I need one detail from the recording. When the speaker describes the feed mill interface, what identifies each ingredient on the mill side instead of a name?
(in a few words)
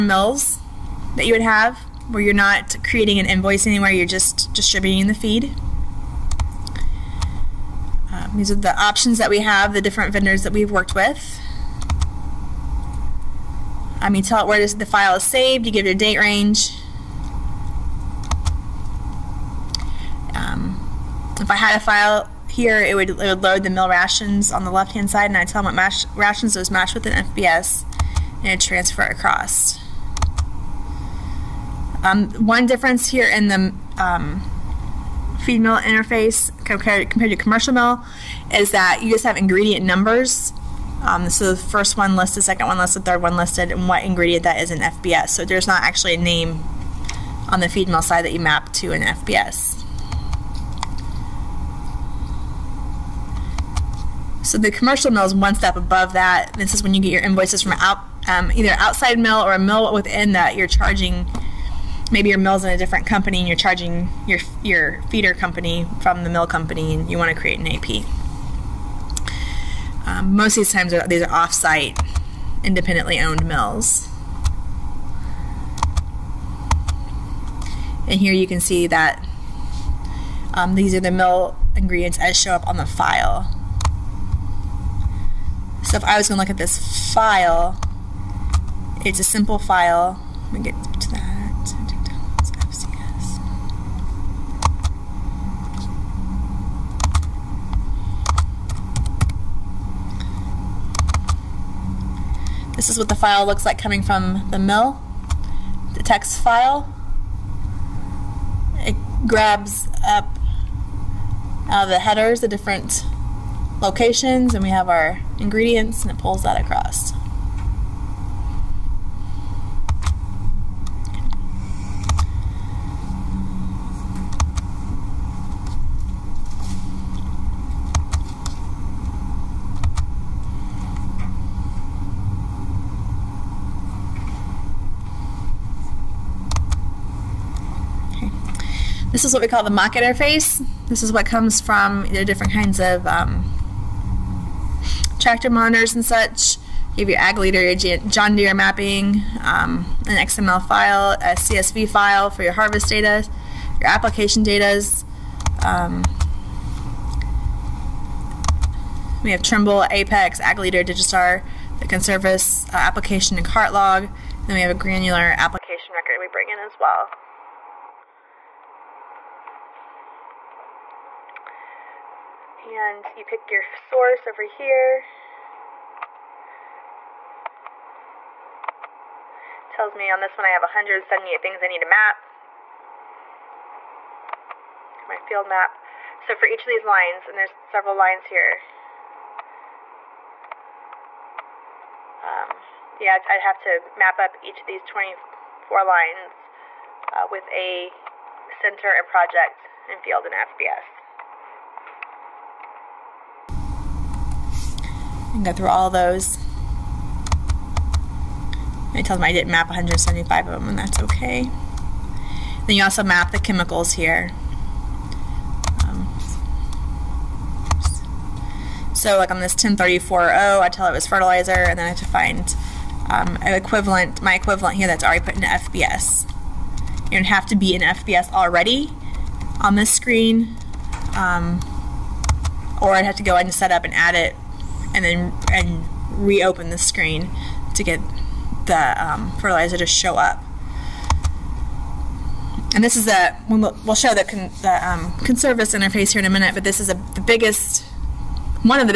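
ingredient numbers.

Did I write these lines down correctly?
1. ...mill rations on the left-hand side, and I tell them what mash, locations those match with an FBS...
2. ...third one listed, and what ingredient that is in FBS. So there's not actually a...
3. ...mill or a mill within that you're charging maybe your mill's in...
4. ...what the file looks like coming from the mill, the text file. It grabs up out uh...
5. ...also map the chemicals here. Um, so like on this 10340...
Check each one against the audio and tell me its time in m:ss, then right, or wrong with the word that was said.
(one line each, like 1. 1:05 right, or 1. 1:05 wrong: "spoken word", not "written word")
1. 0:23 wrong: "rations", not "locations"
2. 0:43 right
3. 0:59 right
4. 1:42 right
5. 3:32 right.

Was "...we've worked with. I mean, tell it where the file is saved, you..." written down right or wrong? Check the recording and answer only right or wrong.
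right.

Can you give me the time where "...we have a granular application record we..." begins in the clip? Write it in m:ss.
2:44.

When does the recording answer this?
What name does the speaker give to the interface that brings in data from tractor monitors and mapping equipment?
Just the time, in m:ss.
2:19.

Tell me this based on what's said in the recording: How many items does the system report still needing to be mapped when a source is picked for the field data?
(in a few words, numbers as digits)
178.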